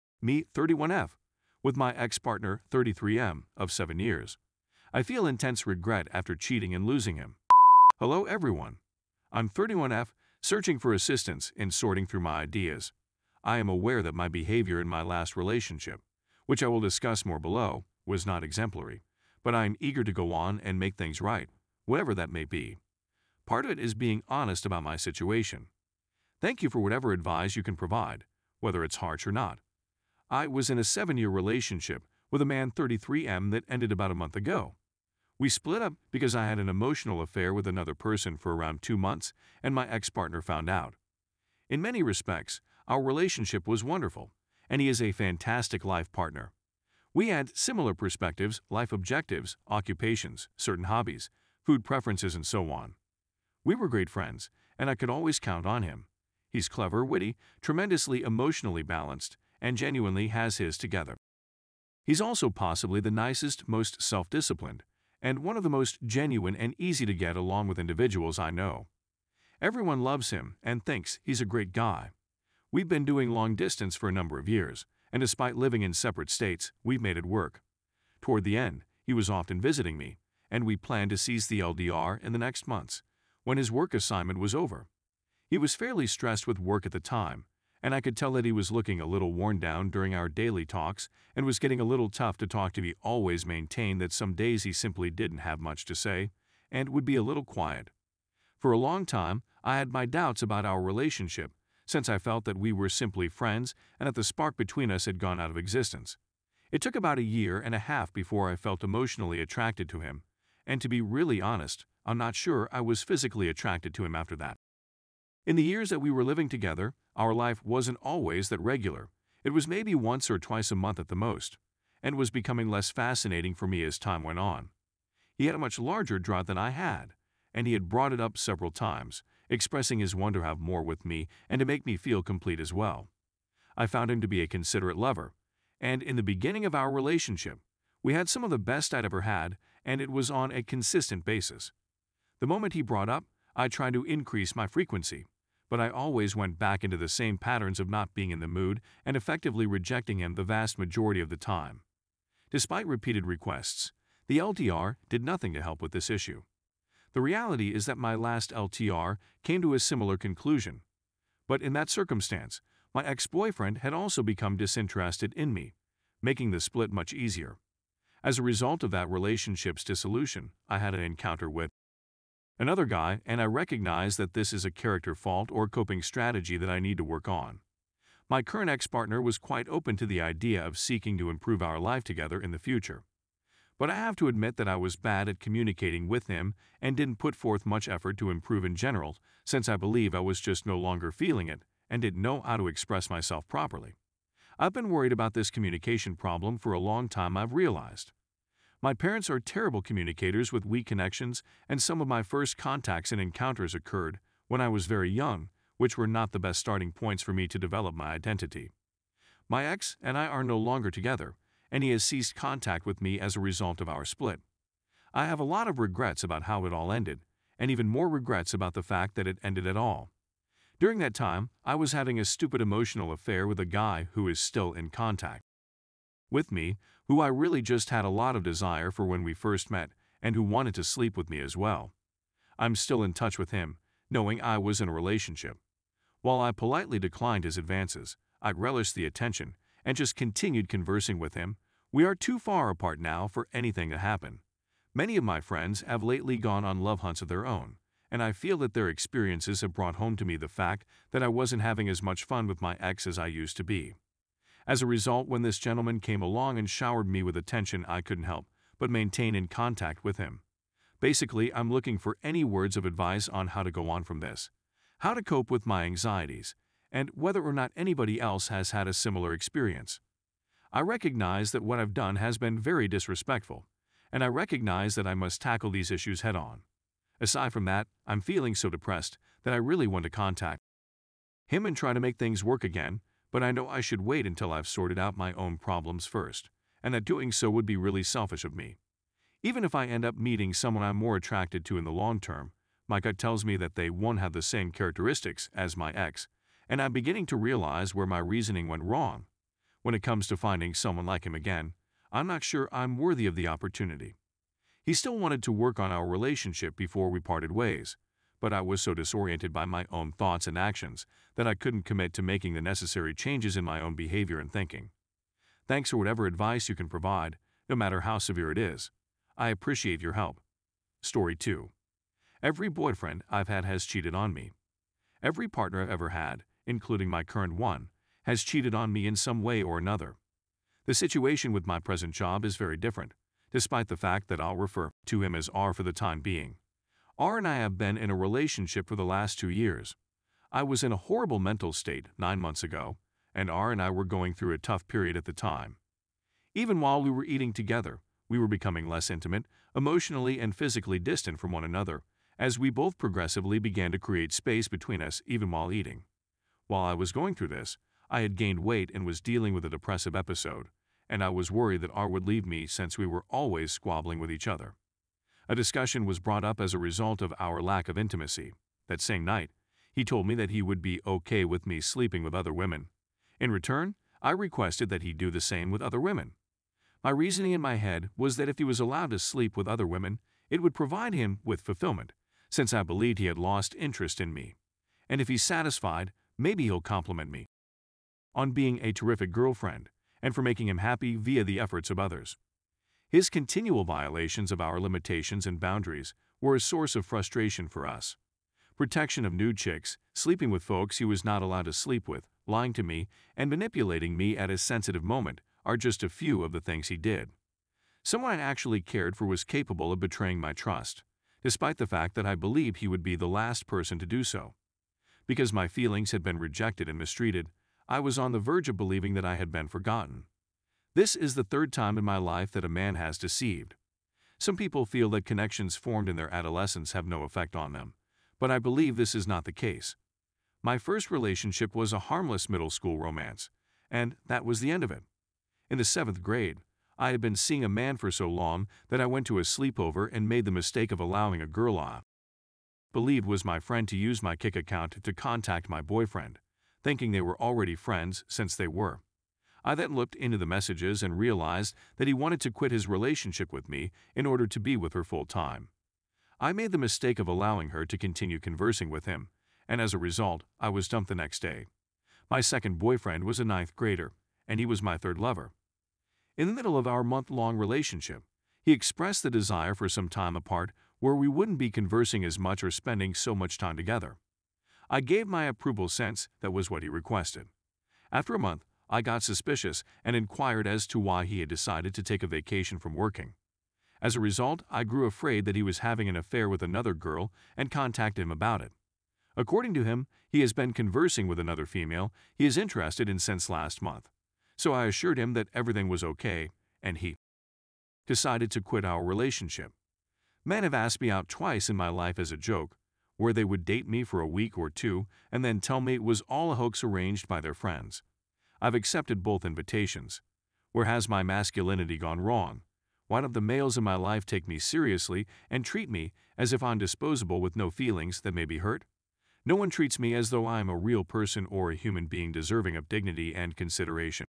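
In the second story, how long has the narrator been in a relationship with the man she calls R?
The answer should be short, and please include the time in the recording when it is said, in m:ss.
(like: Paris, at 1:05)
2 years, at 5:39.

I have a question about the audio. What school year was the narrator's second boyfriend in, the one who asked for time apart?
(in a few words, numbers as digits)
ninth grader.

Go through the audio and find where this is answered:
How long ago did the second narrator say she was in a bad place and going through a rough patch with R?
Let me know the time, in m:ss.
5:42.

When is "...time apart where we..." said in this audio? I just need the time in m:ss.
7:50.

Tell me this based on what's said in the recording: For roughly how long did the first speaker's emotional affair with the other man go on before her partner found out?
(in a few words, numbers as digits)
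around 2 months.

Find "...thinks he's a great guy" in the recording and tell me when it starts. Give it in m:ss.
1:10.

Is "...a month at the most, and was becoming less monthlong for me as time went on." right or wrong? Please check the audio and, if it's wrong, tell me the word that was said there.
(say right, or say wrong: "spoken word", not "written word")
wrong: "fascinating", not "monthlong".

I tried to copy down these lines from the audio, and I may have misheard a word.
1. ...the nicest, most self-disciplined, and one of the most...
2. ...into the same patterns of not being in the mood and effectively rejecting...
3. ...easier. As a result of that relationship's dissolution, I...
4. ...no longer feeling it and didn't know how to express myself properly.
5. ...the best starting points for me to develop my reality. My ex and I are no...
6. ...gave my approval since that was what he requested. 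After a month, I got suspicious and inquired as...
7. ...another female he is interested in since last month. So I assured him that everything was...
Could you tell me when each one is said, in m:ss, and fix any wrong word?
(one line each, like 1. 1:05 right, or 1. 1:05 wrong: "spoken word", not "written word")
1. 1:02 right
2. 2:26 right
3. 2:47 right
4. 3:10 right
5. 3:26 wrong: "identity", not "reality"
6. 7:55 right
7. 8:11 right.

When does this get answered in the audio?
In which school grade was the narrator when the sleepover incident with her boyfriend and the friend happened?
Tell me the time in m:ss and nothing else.
7:15.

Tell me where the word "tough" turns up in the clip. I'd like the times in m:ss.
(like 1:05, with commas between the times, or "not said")
1:32, 5:44.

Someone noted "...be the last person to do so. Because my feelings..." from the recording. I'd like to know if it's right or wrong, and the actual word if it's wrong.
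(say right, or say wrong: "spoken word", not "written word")
right.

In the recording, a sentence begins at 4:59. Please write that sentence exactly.
When it comes to finding someone like him again, I'm not sure I'm worthy of the opportunity.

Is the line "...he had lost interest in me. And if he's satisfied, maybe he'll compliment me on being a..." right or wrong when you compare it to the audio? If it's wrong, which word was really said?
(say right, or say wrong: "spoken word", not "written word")
right.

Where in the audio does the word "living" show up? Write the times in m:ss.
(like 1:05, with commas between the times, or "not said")
1:15, 1:56.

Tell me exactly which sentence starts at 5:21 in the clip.
Story 2 Every boyfriend I've had has cheated on me.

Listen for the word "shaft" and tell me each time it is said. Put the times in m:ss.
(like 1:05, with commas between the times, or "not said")
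not said.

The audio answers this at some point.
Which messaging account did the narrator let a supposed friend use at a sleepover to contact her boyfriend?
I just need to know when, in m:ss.
7:24.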